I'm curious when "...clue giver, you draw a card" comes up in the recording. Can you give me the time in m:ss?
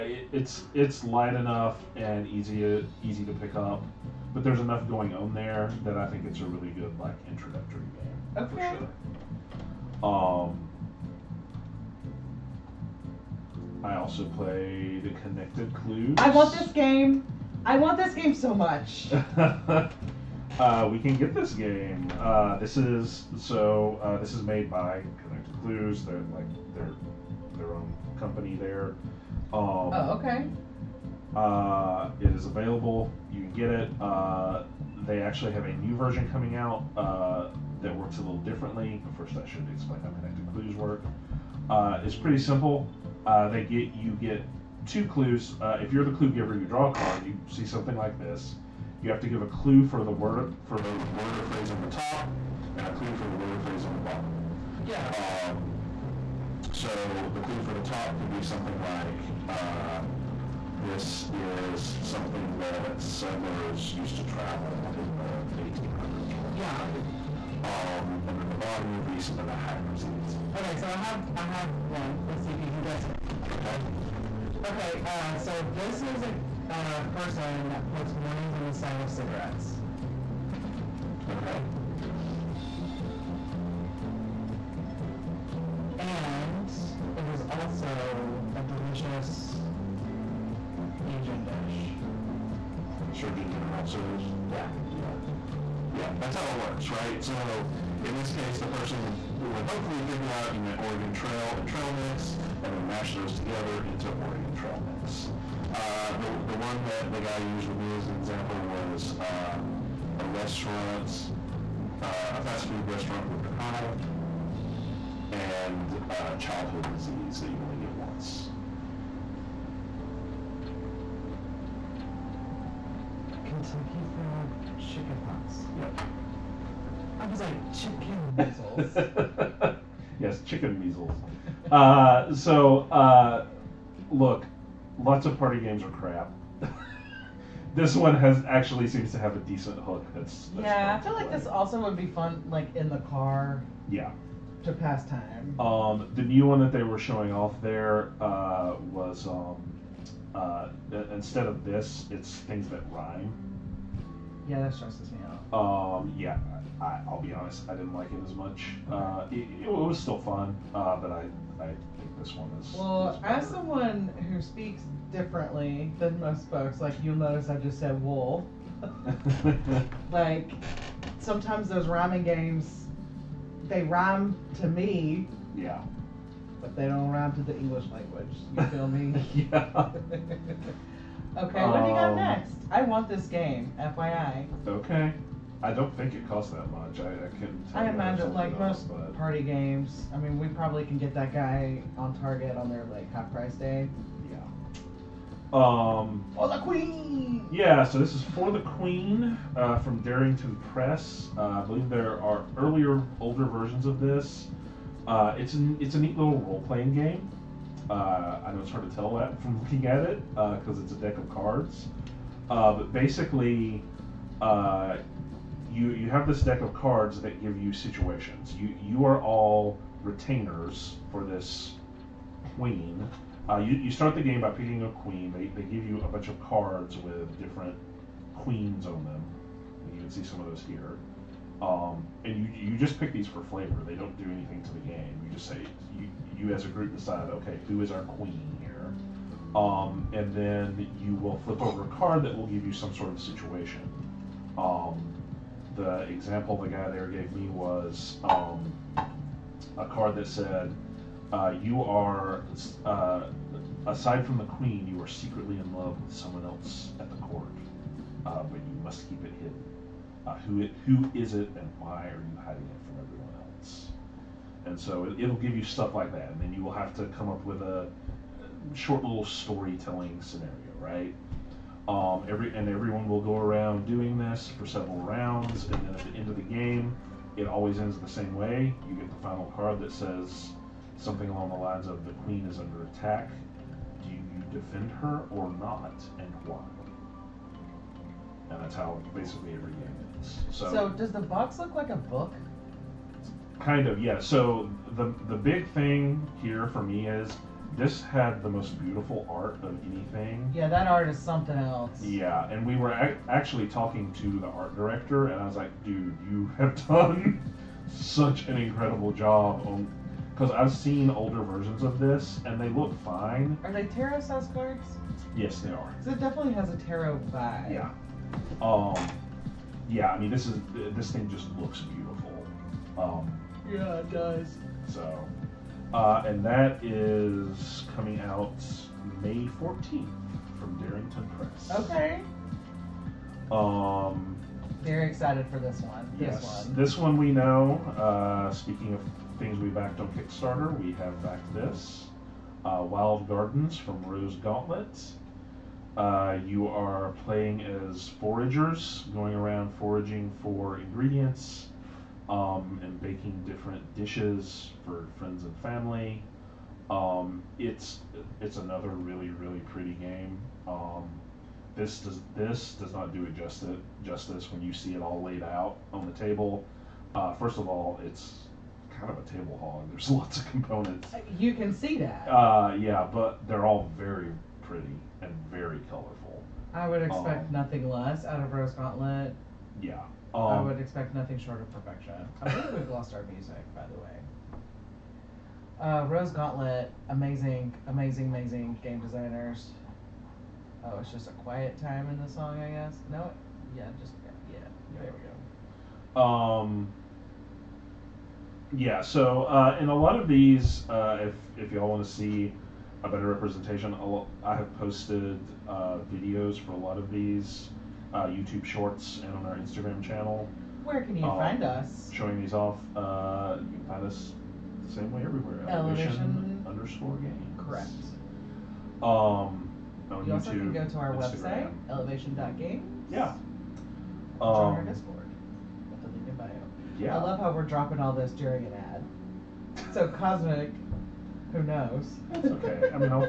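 0:46.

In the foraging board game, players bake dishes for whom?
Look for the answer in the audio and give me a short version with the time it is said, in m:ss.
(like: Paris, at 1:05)
Friends and family, at 5:55.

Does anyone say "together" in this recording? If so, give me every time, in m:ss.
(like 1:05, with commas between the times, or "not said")
1:43.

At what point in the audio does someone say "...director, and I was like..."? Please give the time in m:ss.
5:04.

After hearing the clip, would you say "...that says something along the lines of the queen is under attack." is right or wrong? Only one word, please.
right.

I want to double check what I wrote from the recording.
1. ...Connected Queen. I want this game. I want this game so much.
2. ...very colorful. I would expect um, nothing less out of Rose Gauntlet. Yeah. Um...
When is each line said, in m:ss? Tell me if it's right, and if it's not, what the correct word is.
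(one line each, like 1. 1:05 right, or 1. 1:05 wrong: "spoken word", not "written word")
1. 0:15 wrong: "Clues", not "Queen"
2. 6:15 right.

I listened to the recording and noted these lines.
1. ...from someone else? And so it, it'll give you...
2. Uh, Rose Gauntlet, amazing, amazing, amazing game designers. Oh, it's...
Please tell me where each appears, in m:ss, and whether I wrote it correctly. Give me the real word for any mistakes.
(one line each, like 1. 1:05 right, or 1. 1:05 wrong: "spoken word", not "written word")
1. 4:22 wrong: "everyone", not "someone"
2. 6:25 right.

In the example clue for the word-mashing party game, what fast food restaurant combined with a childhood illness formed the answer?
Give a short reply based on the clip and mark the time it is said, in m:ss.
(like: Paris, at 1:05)
Kentucky Fried Chicken Pox, at 2:03.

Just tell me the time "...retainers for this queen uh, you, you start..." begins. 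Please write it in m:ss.
3:40.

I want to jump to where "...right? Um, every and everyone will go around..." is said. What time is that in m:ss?
4:30.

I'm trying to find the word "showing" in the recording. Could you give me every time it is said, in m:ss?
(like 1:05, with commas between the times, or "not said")
2:26, 6:52.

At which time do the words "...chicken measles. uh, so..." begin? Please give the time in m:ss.
2:10.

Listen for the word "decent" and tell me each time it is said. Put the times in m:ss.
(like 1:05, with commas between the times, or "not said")
2:19.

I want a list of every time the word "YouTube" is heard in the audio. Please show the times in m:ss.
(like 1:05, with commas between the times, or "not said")
6:48, 7:00.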